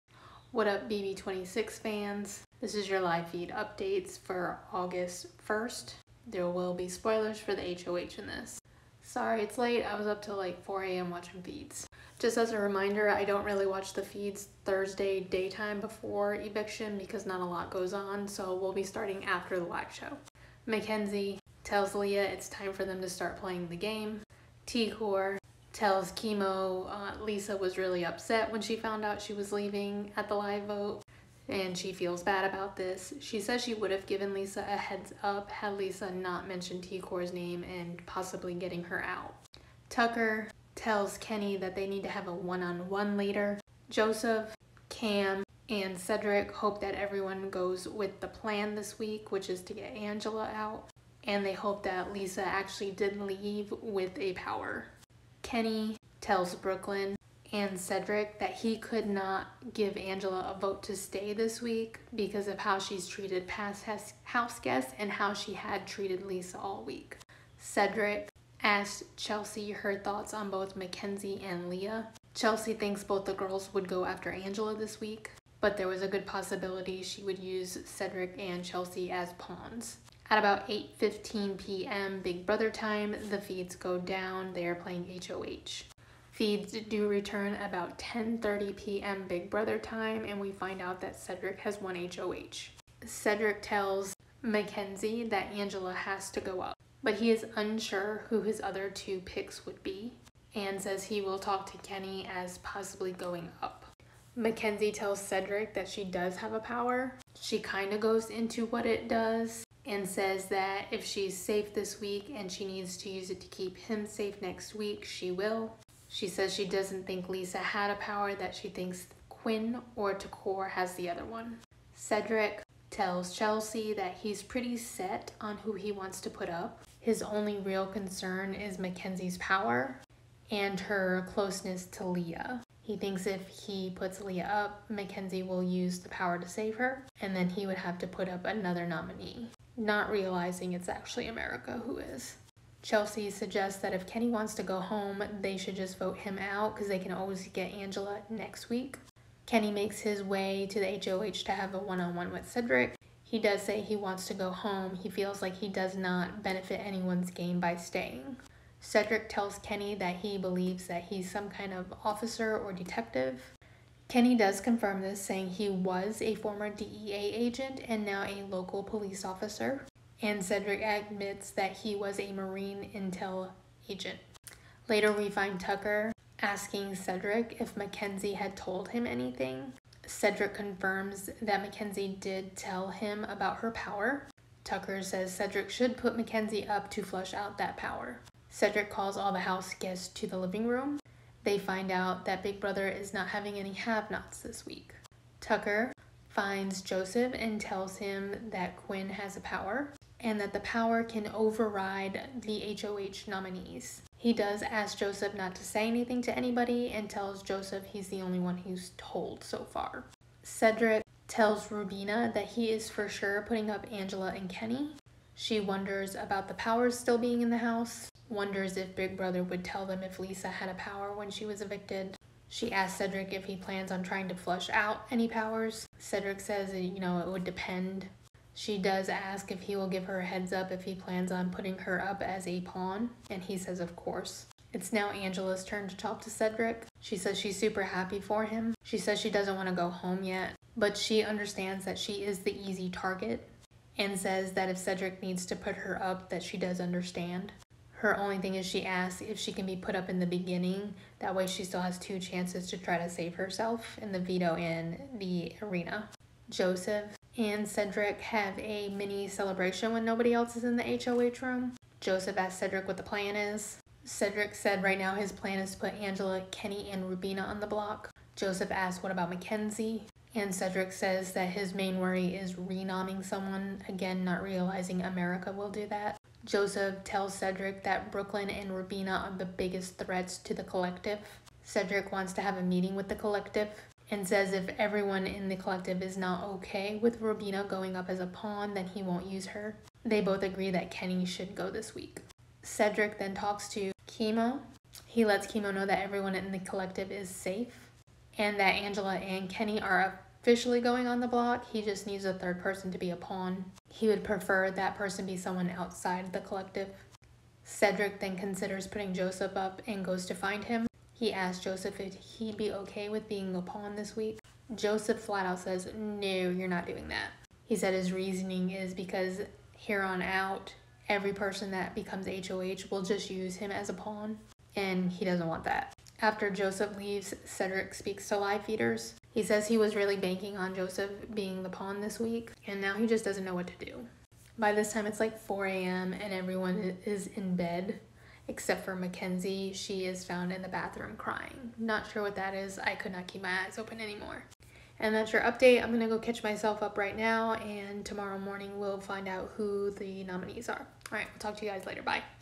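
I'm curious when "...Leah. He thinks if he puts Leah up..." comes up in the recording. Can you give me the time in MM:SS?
02:12.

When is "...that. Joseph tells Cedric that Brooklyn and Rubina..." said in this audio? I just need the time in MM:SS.
04:35.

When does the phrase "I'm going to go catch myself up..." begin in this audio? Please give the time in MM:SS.
05:45.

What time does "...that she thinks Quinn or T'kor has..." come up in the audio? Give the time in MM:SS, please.
01:58.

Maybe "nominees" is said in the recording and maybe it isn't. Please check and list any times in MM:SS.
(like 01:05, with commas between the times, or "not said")
02:18, 03:23, 05:50.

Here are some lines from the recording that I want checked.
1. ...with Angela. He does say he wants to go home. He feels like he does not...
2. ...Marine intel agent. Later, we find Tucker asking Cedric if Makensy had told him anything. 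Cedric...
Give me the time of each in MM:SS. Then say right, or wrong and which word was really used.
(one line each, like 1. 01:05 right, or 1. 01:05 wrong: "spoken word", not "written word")
1. 02:32 wrong: "Cedric", not "Angela"
2. 02:52 right.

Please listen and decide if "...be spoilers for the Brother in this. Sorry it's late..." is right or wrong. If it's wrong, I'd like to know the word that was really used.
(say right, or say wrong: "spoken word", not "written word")
wrong: "HOH", not "Brother".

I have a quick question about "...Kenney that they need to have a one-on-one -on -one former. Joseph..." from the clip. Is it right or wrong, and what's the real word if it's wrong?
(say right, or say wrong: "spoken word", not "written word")
wrong: "later", not "former".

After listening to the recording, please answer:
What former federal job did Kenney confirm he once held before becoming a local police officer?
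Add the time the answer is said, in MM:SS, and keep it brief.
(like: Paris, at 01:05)
DEA agent, at 02:46.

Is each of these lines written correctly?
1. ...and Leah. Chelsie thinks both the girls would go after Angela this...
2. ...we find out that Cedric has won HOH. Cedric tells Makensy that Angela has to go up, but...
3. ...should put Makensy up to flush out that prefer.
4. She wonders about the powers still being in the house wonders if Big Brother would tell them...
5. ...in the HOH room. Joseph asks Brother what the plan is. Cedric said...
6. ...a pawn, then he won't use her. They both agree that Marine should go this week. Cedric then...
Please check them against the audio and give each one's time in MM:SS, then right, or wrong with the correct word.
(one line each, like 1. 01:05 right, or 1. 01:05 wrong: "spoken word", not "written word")
1. 01:11 right
2. 01:30 right
3. 03:05 wrong: "power", not "prefer"
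4. 03:35 right
5. 04:20 wrong: "Cedric", not "Brother"
6. 04:48 wrong: "Kenney", not "Marine".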